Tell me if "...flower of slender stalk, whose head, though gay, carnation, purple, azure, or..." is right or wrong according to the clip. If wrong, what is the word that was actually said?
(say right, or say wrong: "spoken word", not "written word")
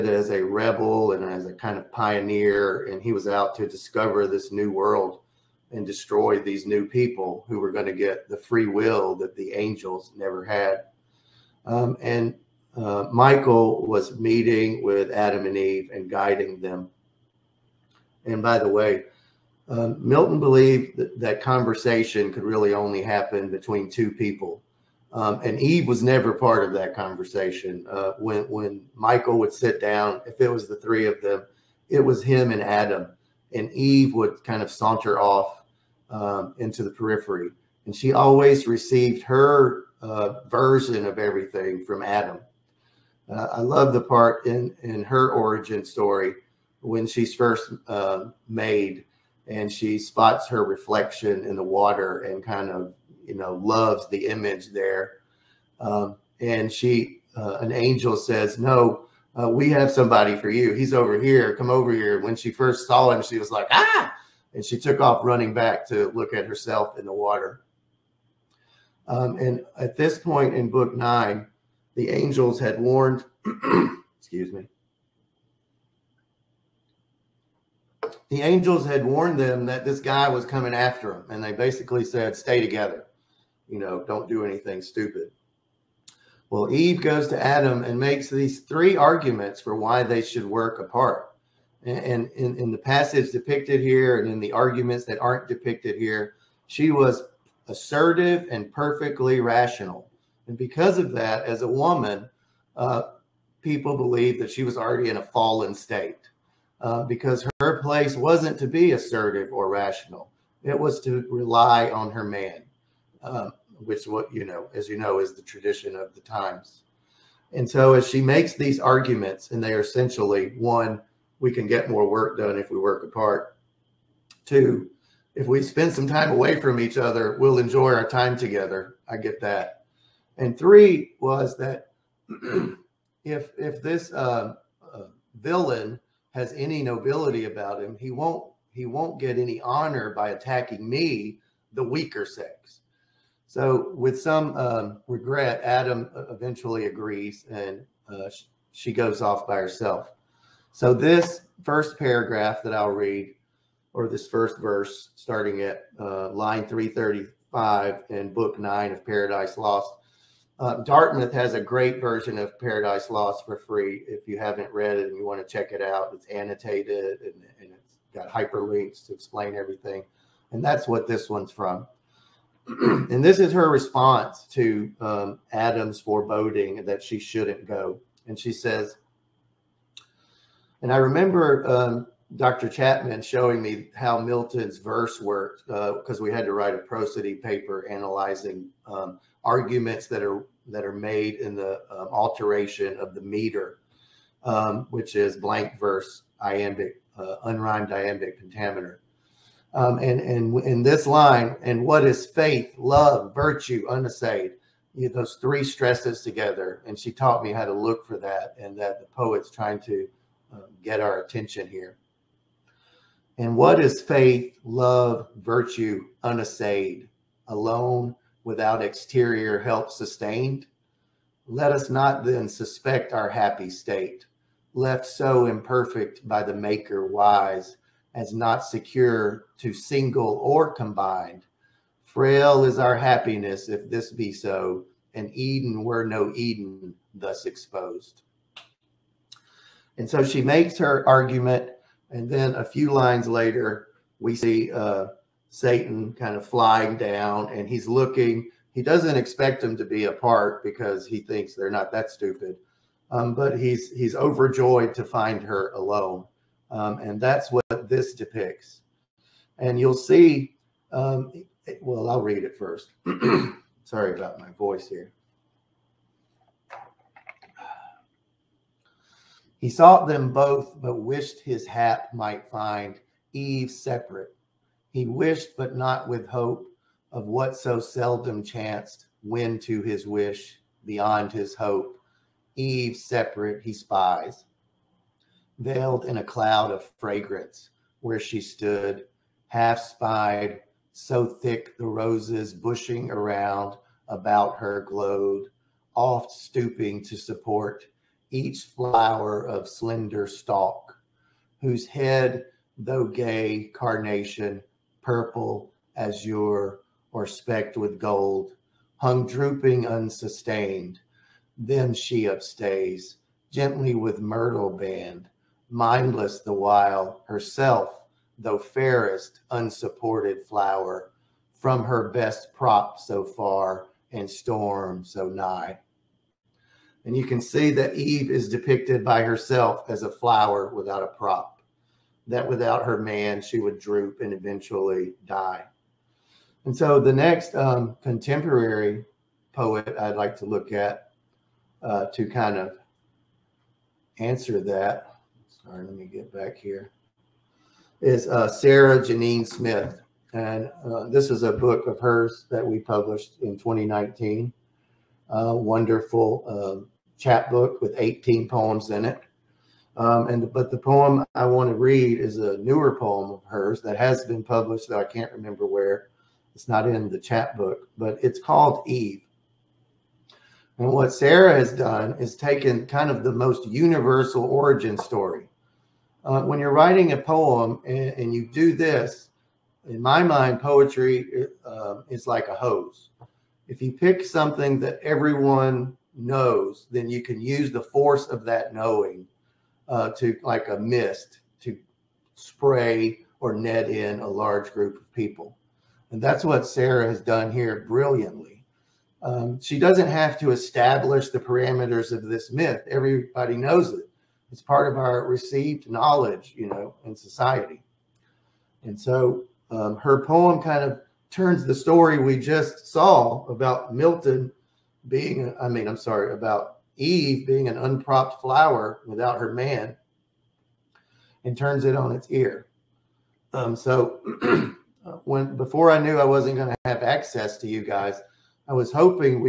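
right.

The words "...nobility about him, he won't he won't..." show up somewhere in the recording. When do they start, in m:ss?
2:16.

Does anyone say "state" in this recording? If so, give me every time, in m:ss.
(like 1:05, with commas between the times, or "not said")
1:45, 3:43.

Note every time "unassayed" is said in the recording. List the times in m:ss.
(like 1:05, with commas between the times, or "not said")
3:23, 3:36.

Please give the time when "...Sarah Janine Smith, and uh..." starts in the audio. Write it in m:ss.
5:48.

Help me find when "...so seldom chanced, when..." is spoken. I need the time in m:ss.
4:37.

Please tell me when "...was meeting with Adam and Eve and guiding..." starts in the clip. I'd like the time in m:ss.
0:13.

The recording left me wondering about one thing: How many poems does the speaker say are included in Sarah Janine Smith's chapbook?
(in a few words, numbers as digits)
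18.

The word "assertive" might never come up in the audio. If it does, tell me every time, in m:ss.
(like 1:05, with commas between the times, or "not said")
1:37, 1:48.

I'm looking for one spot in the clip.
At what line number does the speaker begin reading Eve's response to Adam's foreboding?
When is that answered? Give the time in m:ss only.
2:36.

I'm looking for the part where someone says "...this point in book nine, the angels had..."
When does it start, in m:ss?
1:09.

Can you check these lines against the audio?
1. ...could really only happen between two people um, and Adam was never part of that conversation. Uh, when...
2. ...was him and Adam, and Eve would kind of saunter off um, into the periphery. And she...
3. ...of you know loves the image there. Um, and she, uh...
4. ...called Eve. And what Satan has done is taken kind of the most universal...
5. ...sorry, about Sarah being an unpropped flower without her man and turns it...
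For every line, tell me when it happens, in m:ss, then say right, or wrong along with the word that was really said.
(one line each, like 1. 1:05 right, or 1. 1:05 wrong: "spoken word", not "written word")
1. 0:22 wrong: "Eve", not "Adam"
2. 0:31 right
3. 0:52 right
4. 6:08 wrong: "Sarah", not "Satan"
5. 6:55 wrong: "Eve", not "Sarah".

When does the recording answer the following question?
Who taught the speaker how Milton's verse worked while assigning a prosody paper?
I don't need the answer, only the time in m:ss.
3:02.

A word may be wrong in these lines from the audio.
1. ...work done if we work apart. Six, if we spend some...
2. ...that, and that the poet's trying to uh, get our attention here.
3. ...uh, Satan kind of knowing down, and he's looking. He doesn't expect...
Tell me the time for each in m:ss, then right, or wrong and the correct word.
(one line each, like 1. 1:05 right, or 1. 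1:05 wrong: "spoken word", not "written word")
1. 2:02 wrong: "Two", not "Six"
2. 3:28 right
3. 4:04 wrong: "flying", not "knowing".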